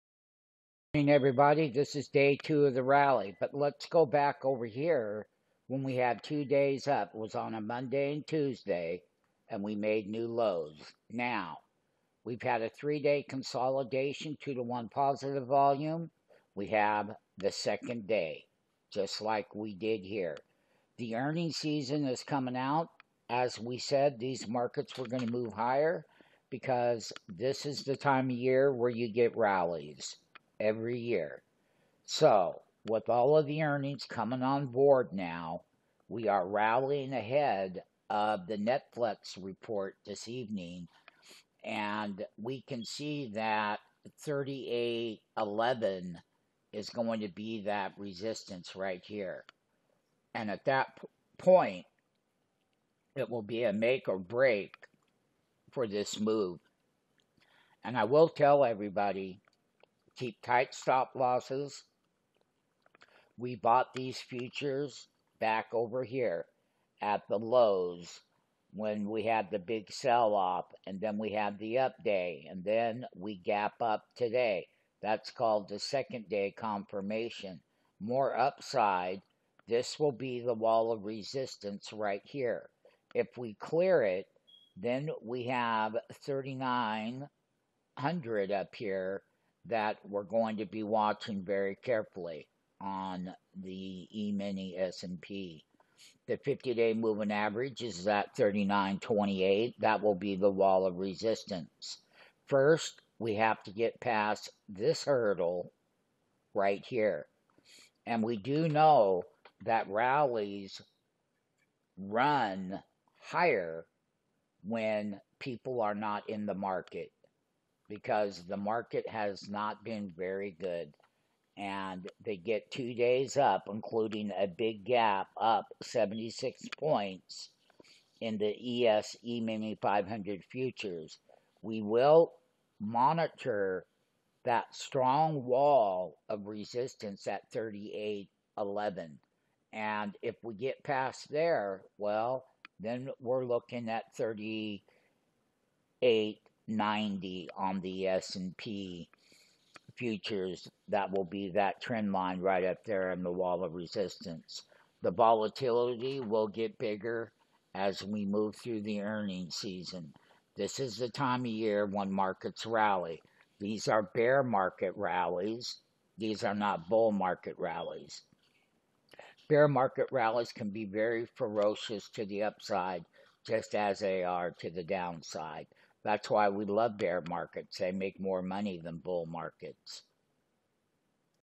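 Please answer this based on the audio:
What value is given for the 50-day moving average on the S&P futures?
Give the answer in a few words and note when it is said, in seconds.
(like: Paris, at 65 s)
39.28, at 98 s.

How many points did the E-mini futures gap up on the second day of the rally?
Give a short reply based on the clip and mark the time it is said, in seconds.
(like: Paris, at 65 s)
76, at 125 s.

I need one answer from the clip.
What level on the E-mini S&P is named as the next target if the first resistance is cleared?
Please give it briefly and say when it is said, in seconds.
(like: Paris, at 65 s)
3900, at 86 s.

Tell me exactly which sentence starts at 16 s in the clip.
We have the second day, just like we did here.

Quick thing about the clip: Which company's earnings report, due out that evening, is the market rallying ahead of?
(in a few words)
Netflix.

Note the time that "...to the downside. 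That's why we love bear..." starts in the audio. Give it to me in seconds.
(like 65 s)
174 s.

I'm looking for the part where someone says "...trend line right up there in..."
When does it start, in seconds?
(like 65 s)
151 s.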